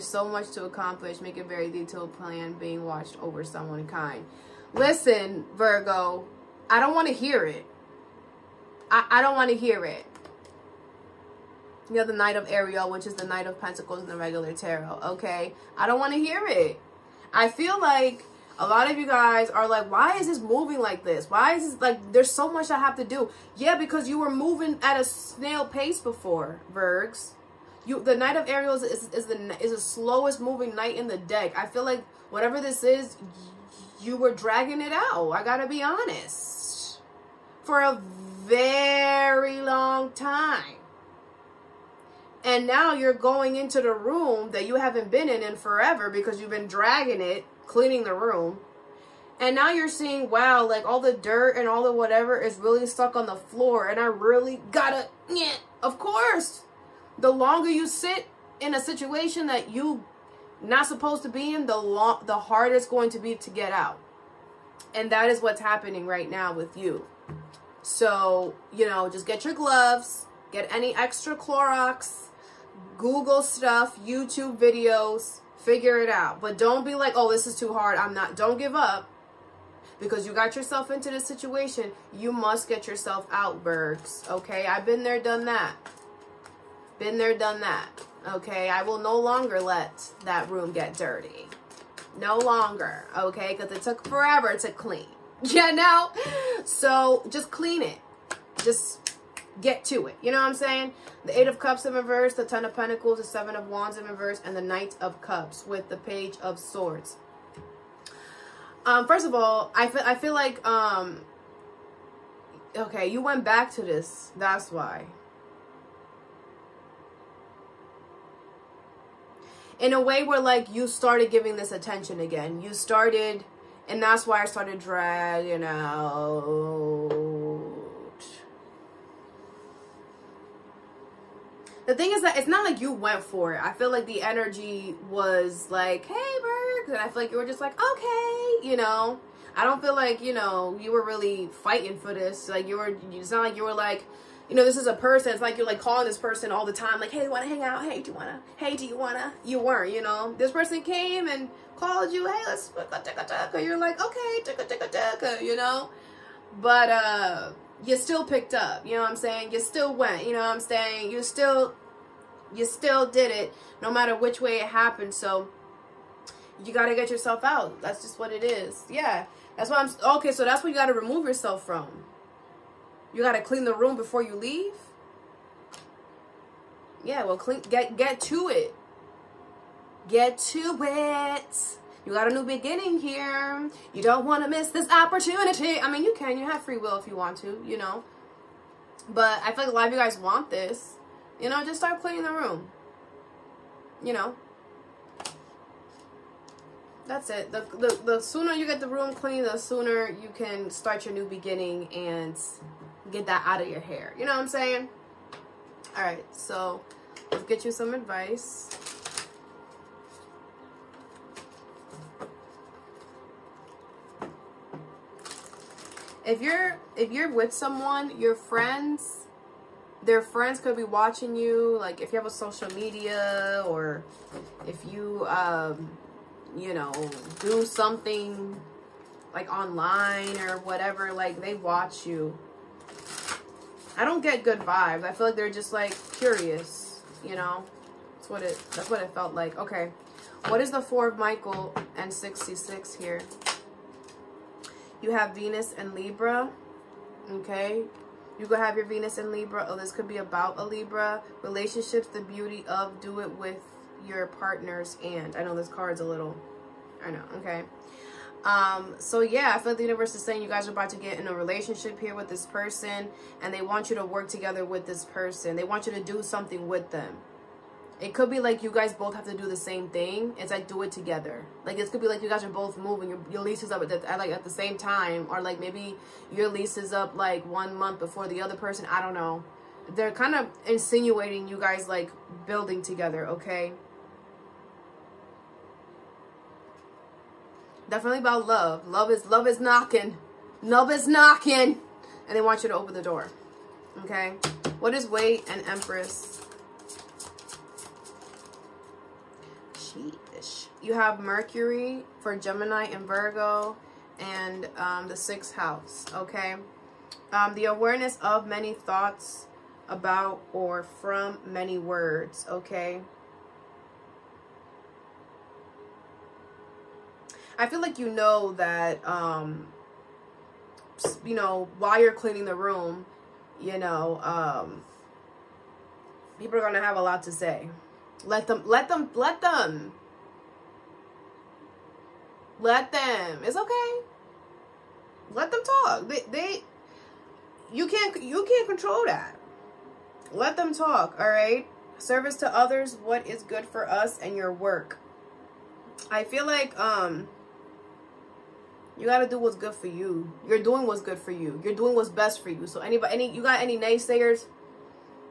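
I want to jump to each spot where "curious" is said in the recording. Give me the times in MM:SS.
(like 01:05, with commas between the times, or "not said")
03:56.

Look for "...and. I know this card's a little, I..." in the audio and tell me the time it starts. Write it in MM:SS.
04:15.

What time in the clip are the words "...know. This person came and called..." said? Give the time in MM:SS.
02:30.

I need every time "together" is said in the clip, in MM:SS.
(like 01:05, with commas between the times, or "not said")
04:24, 04:30, 04:42.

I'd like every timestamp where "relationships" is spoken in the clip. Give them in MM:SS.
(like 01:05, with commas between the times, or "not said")
04:11, 04:21.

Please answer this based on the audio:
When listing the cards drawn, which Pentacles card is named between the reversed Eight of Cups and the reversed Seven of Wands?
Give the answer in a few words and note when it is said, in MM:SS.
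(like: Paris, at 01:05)
Ten of Pentacles, at 01:42.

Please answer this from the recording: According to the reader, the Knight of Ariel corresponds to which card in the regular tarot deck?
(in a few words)
Knight of Pentacles.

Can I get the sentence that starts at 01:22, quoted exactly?
You must get yourself out, Virgs.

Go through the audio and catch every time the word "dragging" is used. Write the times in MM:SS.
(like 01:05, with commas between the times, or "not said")
00:34, 00:46, 02:04.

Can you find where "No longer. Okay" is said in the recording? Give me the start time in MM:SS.
01:32.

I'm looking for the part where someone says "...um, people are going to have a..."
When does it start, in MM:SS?
05:24.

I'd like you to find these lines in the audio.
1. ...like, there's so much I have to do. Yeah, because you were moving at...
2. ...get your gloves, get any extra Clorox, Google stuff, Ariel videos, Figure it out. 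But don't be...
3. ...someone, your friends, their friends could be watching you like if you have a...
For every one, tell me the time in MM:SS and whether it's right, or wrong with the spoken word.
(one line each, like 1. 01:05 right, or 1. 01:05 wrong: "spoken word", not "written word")
1. 00:21 right
2. 01:09 wrong: "YouTube", not "Ariel"
3. 03:37 right.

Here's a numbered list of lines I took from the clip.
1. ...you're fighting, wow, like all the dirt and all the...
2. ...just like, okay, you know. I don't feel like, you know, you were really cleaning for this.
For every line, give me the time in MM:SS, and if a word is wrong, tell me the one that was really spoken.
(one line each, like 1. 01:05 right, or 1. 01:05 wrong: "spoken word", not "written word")
1. 00:49 wrong: "seeing", not "fighting"
2. 02:17 wrong: "fighting", not "cleaning".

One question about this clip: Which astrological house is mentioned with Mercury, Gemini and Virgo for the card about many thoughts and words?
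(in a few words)
sixth house.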